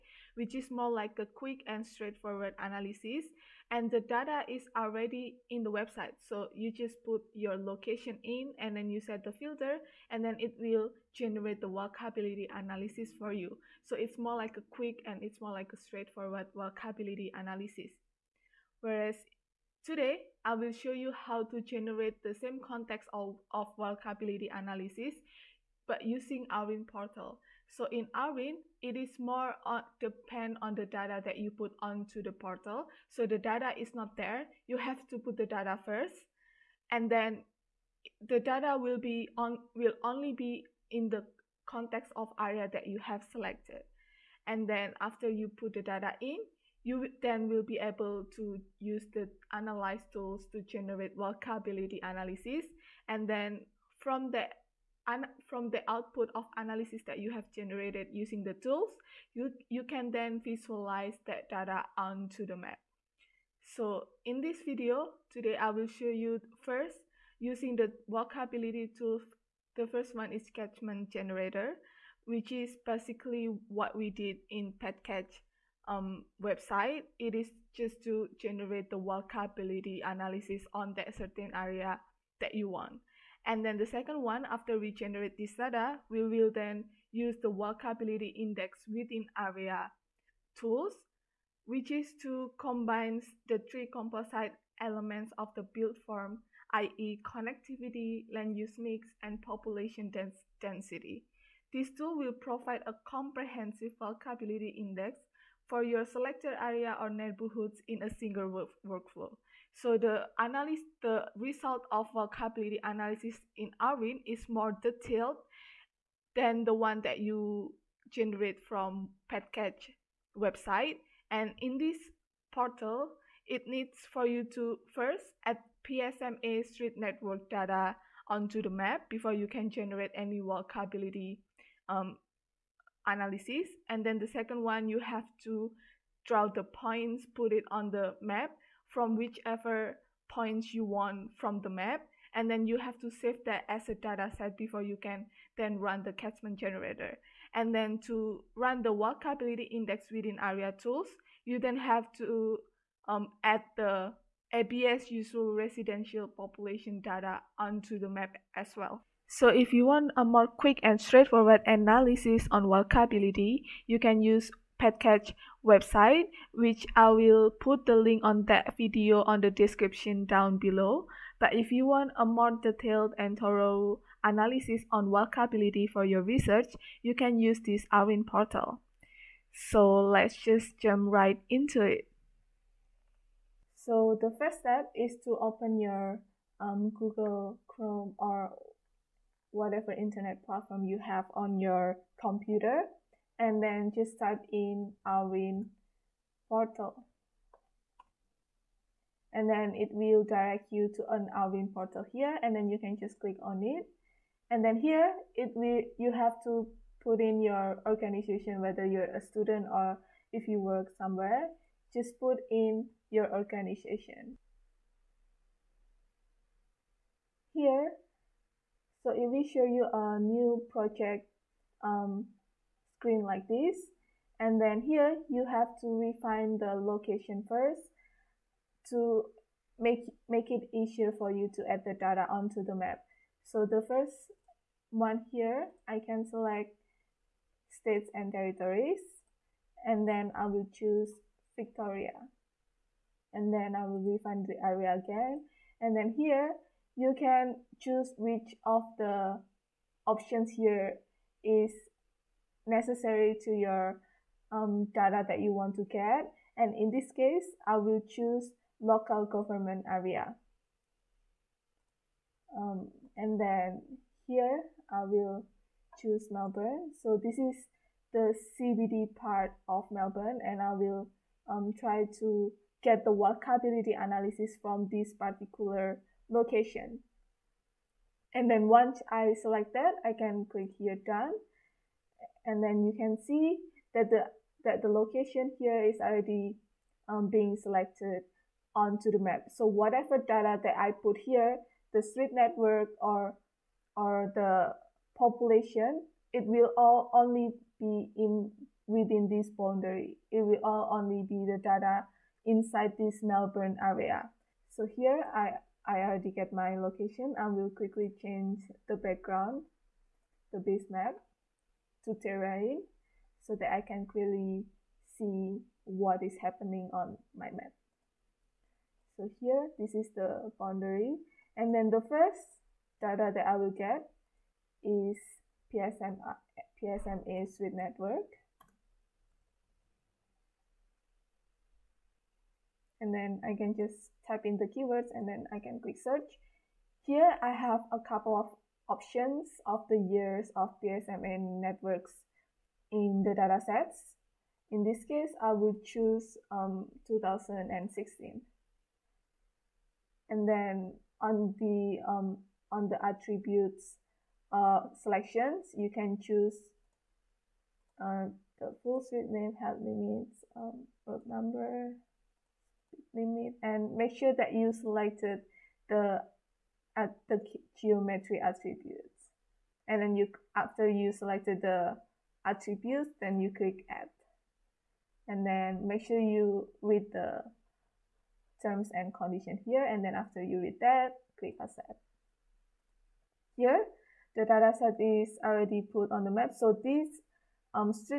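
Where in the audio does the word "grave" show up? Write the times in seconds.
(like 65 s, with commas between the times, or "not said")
not said.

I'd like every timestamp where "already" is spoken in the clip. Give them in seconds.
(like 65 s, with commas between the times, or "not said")
4 s, 286 s, 306 s, 385 s.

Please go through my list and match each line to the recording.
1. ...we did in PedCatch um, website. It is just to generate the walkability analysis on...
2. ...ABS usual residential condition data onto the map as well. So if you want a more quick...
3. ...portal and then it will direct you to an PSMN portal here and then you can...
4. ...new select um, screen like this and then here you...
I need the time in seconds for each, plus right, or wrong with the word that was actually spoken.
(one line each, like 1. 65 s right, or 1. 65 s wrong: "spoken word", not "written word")
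1. 73 s right
2. 154 s wrong: "population", not "condition"
3. 196 s wrong: "AURIN", not "PSMN"
4. 220 s wrong: "project", not "select".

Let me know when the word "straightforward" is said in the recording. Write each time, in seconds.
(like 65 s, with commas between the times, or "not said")
1 s, 15 s, 161 s.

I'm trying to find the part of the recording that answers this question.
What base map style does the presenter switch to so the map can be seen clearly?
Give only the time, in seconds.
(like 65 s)
312 s.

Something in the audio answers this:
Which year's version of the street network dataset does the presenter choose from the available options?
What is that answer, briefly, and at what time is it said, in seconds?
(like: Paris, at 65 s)
2016, at 347 s.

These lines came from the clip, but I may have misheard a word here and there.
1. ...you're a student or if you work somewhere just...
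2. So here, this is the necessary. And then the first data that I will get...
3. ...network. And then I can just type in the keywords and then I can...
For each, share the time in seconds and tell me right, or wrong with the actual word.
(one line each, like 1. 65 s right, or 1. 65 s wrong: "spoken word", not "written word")
1. 208 s right
2. 319 s wrong: "boundary", not "necessary"
3. 327 s right.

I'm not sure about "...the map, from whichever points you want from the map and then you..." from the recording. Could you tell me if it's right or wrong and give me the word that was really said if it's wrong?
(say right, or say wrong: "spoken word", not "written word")
right.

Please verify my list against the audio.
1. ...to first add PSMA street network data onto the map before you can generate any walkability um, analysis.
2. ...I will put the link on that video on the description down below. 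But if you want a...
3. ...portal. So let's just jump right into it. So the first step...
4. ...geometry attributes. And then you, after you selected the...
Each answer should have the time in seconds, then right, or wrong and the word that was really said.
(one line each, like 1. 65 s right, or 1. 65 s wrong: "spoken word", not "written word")
1. 124 s right
2. 166 s right
3. 178 s right
4. 367 s right.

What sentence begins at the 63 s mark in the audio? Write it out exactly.
So in this video, today I will show you first using the walkability tool.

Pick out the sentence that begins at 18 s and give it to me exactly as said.
Whereas Today, I will show you how to generate the same context of, of analysis, but using AURIN portal.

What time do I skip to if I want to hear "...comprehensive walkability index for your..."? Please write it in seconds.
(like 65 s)
103 s.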